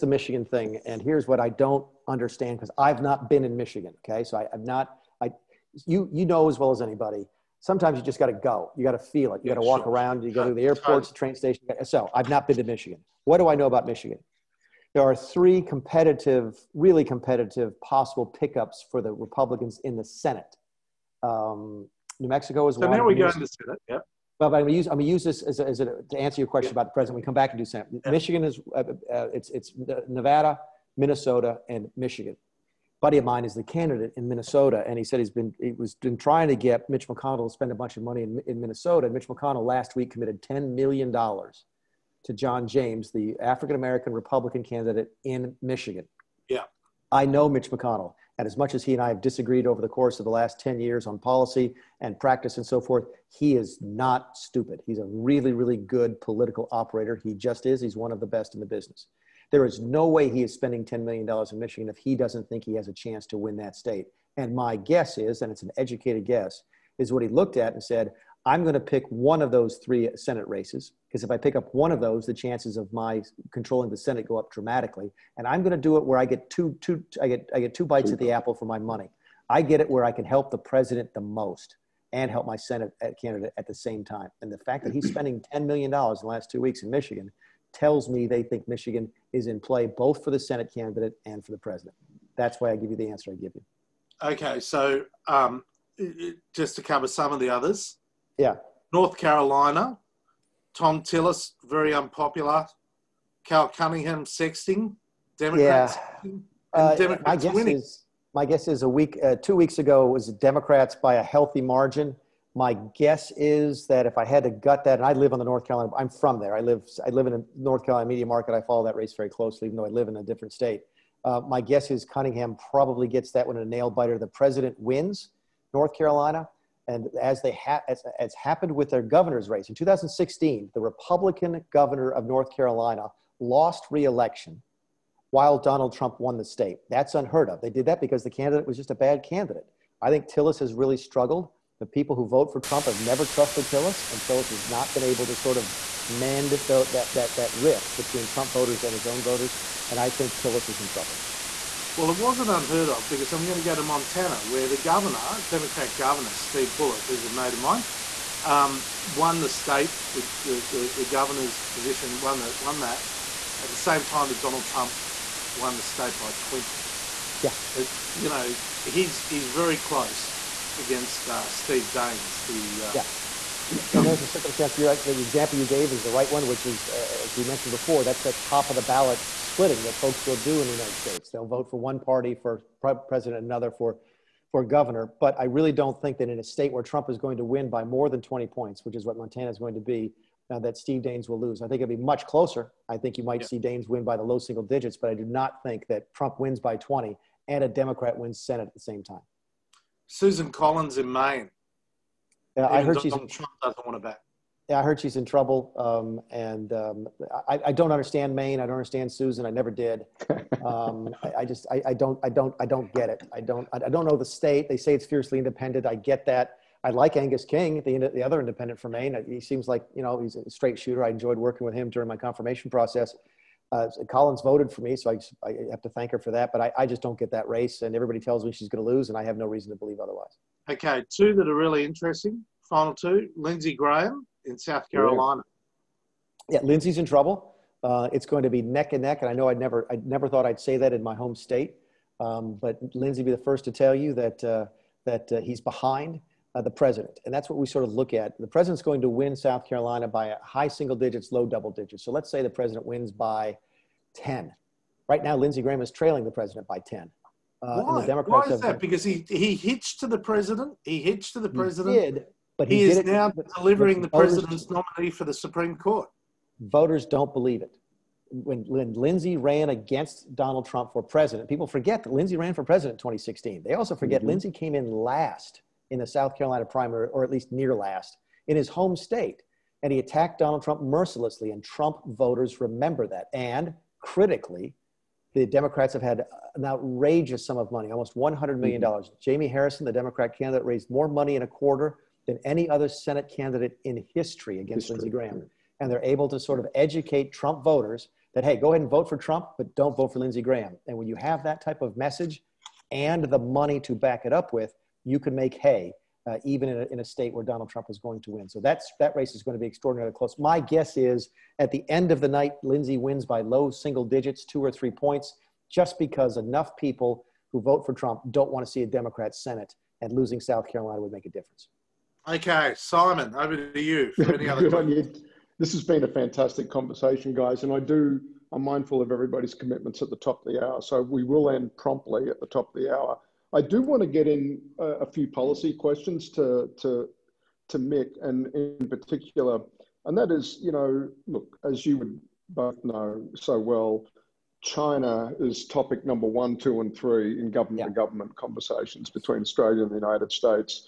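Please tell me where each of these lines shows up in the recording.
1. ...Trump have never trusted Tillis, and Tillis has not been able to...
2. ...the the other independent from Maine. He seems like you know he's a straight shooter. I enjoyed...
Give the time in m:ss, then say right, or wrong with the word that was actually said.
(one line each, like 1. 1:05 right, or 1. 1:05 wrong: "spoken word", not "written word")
1. 2:22 right
2. 3:37 right.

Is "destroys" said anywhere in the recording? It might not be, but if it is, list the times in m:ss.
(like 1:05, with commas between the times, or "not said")
not said.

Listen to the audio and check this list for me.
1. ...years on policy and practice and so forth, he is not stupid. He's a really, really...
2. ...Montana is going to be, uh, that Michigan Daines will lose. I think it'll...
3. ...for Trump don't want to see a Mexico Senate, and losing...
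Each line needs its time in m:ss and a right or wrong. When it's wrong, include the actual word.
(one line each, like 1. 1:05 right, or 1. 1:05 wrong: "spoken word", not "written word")
1. 0:50 right
2. 3:09 wrong: "Steve", not "Michigan"
3. 5:17 wrong: "Democrat", not "Mexico".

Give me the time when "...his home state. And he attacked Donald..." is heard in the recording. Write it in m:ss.
4:38.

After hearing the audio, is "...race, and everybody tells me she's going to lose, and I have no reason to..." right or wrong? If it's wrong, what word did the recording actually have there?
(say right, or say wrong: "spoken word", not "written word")
right.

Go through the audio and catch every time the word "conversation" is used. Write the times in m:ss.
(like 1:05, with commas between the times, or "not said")
5:26, 5:48.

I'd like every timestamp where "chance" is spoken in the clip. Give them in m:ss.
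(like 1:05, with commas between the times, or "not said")
1:02, 1:12.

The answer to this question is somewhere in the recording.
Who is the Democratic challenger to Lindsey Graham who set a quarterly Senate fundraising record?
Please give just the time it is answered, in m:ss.
4:49.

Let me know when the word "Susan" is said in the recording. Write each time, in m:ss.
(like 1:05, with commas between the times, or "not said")
3:20, 3:29.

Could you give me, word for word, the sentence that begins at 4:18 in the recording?
Because he, he hitched to the president.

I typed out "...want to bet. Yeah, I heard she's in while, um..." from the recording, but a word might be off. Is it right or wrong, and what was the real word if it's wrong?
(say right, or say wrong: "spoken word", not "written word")
wrong: "trouble", not "while".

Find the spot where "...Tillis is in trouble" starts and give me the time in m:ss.
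2:30.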